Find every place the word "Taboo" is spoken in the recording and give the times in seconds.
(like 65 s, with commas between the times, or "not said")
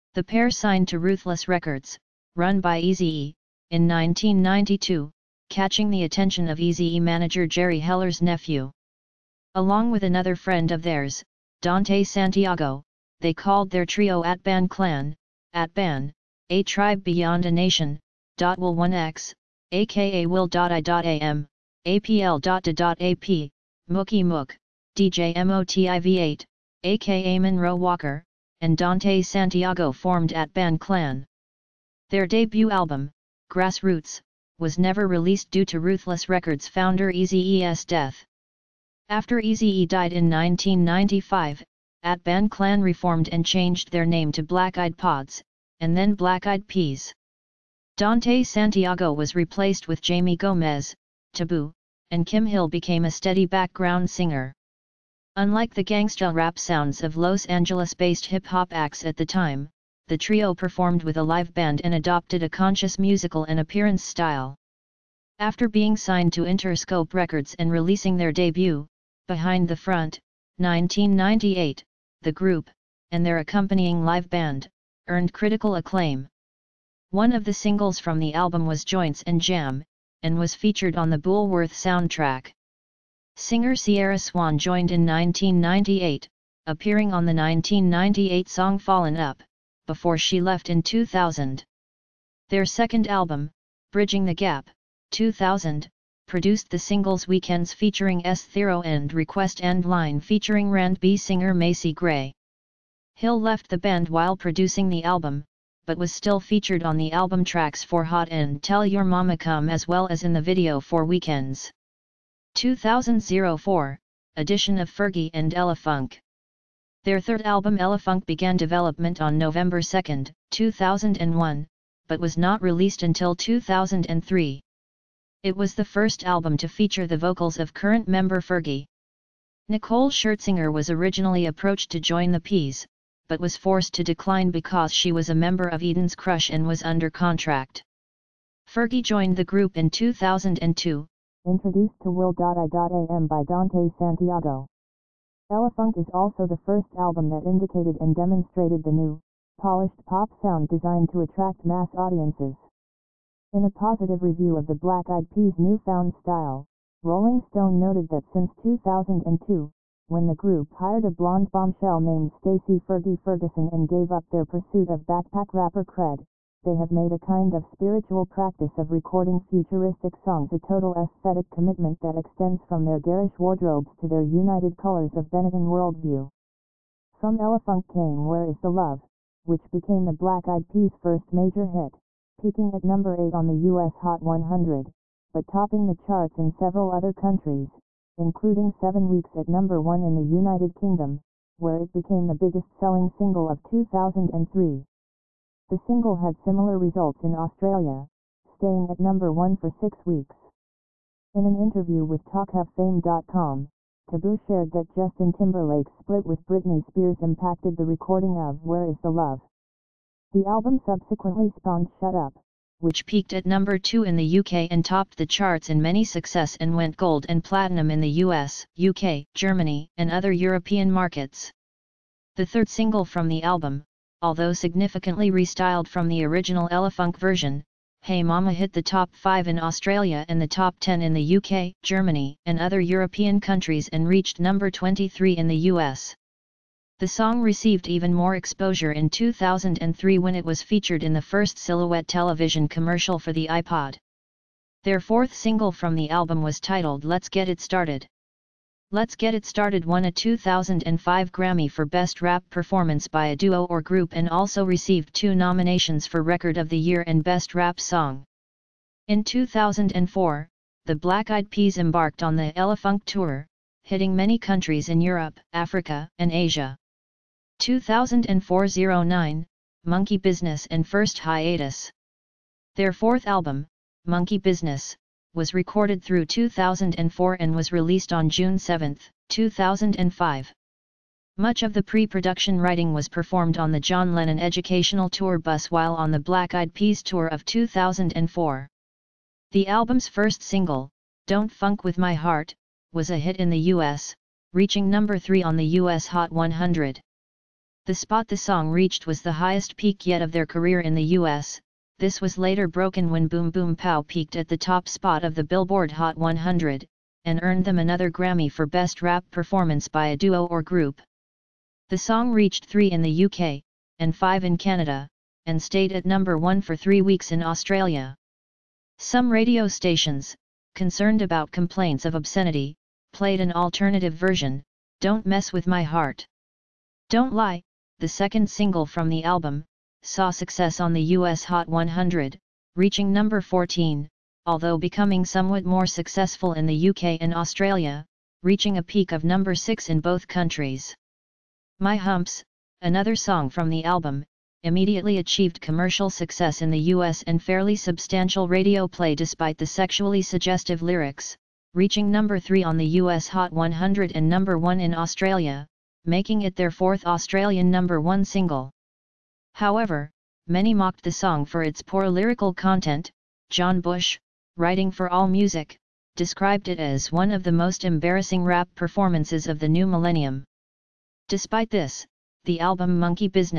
51 s, 204 s.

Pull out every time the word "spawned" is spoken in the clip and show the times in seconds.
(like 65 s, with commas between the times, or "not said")
211 s.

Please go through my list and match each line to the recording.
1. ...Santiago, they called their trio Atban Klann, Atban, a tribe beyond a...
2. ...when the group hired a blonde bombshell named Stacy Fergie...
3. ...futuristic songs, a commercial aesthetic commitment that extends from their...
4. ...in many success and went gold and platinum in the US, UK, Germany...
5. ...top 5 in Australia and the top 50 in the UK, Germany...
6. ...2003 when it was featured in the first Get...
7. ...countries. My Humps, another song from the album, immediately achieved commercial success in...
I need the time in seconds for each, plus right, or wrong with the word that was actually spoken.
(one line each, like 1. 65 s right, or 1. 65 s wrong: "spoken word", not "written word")
1. 12 s right
2. 160 s right
3. 169 s wrong: "total", not "commercial"
4. 215 s right
5. 228 s wrong: "10", not "50"
6. 239 s wrong: "Silhouette", not "Get"
7. 340 s right.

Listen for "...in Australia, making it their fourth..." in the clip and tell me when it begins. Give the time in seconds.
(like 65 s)
354 s.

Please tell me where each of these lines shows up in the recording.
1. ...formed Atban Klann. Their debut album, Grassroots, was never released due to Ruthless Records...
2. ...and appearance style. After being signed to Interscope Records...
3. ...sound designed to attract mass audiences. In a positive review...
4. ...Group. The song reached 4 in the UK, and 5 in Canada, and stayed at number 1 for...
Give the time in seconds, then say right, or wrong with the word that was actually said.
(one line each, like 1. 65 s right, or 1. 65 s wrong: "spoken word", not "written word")
1. 29 s right
2. 63 s right
3. 150 s right
4. 310 s wrong: "3", not "4".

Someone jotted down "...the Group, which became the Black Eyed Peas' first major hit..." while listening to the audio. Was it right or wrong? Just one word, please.
wrong.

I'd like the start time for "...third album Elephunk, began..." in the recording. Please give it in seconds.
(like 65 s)
117 s.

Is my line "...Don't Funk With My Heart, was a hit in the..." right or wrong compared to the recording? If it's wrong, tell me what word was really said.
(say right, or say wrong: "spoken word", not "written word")
right.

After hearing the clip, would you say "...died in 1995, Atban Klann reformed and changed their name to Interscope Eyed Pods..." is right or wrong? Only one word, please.
wrong.